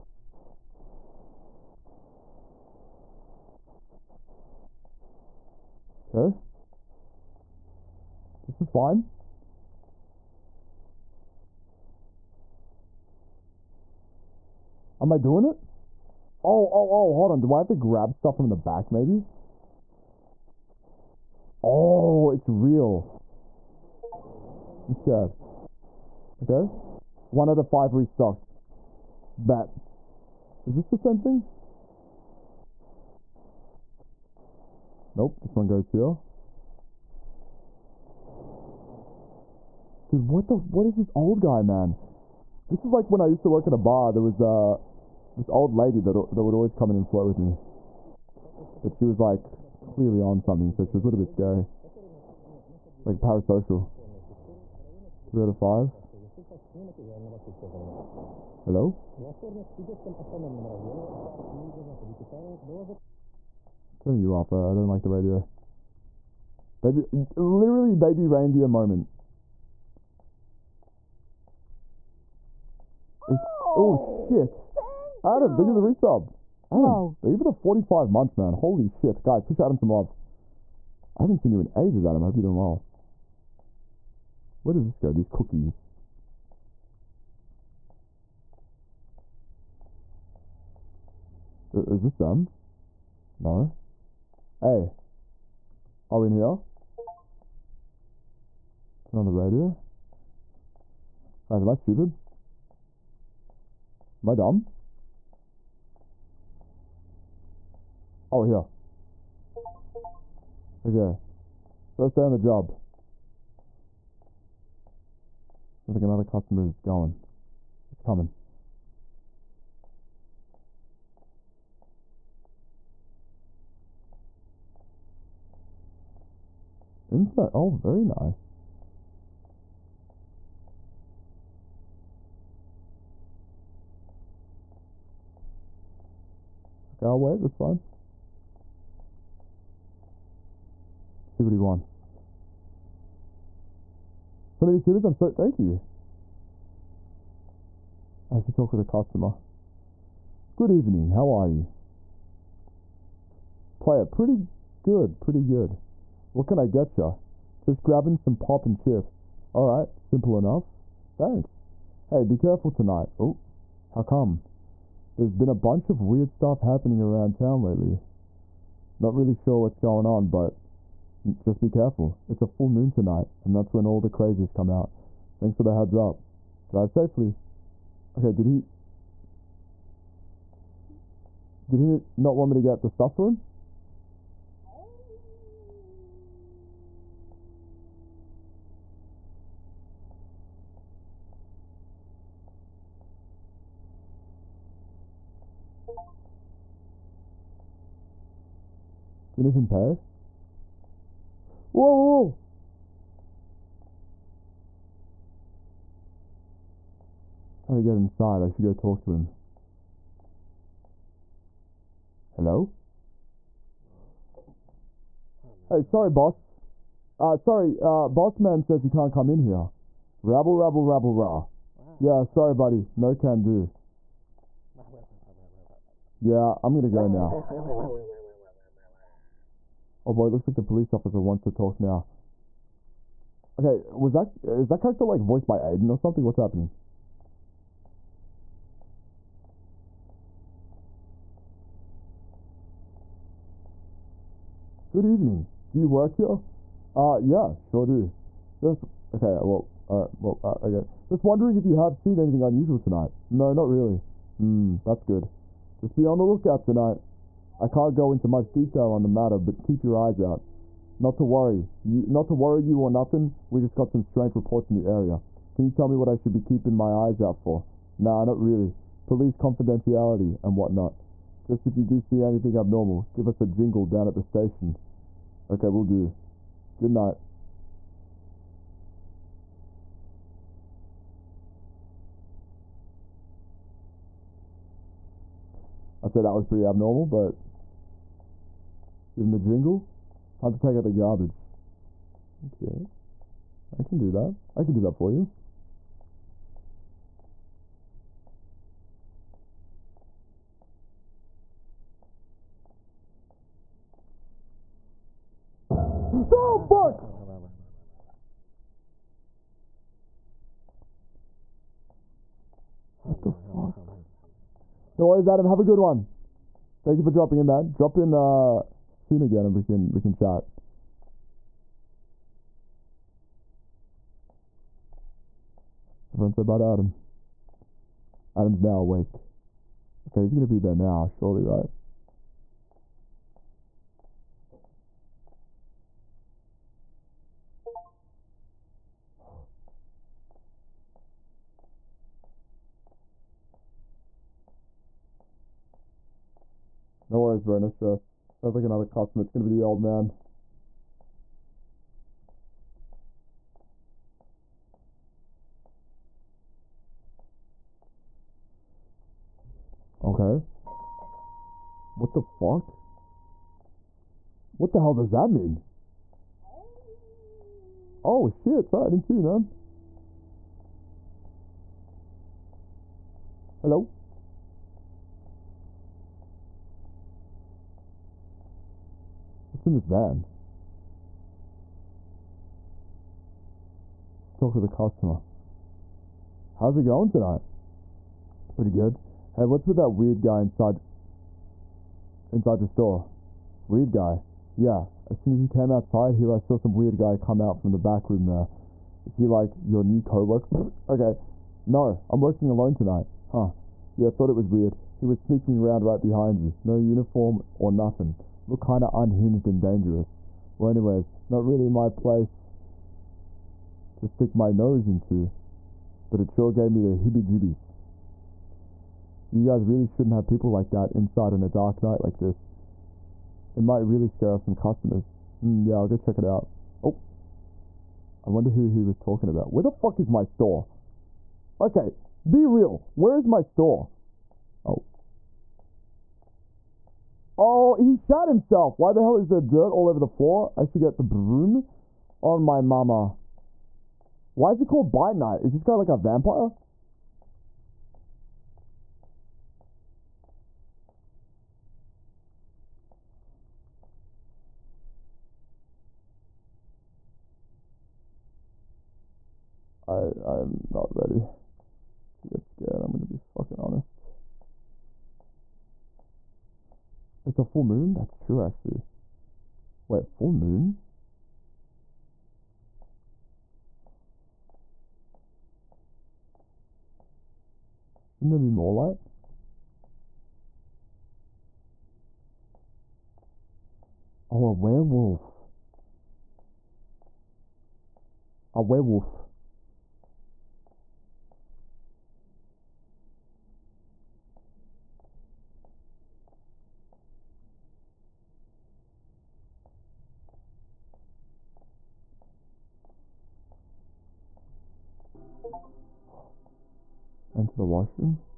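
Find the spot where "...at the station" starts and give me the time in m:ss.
4:34.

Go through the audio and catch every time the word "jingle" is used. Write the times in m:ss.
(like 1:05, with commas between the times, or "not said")
4:33, 4:49.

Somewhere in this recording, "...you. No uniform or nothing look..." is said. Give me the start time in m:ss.
6:46.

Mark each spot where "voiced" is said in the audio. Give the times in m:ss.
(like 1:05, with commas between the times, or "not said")
3:55.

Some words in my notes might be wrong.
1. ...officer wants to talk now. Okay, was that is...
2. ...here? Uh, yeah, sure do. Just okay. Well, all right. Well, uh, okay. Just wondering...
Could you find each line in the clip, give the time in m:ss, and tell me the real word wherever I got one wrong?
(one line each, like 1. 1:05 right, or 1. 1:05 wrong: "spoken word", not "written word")
1. 3:50 right
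2. 4:06 right.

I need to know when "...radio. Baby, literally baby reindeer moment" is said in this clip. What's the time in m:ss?
1:05.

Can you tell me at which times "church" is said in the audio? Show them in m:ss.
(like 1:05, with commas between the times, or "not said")
not said.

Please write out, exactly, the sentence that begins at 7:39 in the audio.
I, I'm not ready to get scared.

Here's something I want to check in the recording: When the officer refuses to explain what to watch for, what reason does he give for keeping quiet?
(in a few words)
Police confidentiality.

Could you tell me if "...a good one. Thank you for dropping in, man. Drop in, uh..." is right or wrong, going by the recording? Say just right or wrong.
right.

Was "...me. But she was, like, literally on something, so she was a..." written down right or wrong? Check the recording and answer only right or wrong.
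wrong.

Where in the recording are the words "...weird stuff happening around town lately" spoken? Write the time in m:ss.
2:46.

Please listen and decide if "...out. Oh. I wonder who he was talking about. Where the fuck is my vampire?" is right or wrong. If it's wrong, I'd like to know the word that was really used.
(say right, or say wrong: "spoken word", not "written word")
wrong: "store", not "vampire".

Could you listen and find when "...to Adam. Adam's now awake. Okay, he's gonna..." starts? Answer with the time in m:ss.
5:26.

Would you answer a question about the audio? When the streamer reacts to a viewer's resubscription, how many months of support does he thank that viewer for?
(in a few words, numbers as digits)
45.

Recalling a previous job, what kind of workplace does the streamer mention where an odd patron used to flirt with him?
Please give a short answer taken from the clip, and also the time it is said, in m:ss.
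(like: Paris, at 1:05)
A bar, at 0:43.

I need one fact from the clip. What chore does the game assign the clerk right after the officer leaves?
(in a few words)
Take out the garbage.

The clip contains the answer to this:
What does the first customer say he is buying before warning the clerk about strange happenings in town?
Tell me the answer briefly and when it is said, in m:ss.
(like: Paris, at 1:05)
Pop and chips, at 2:38.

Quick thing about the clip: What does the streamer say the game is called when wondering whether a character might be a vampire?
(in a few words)
Bite Night.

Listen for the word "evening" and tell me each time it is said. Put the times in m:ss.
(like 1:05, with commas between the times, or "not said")
2:30, 4:05.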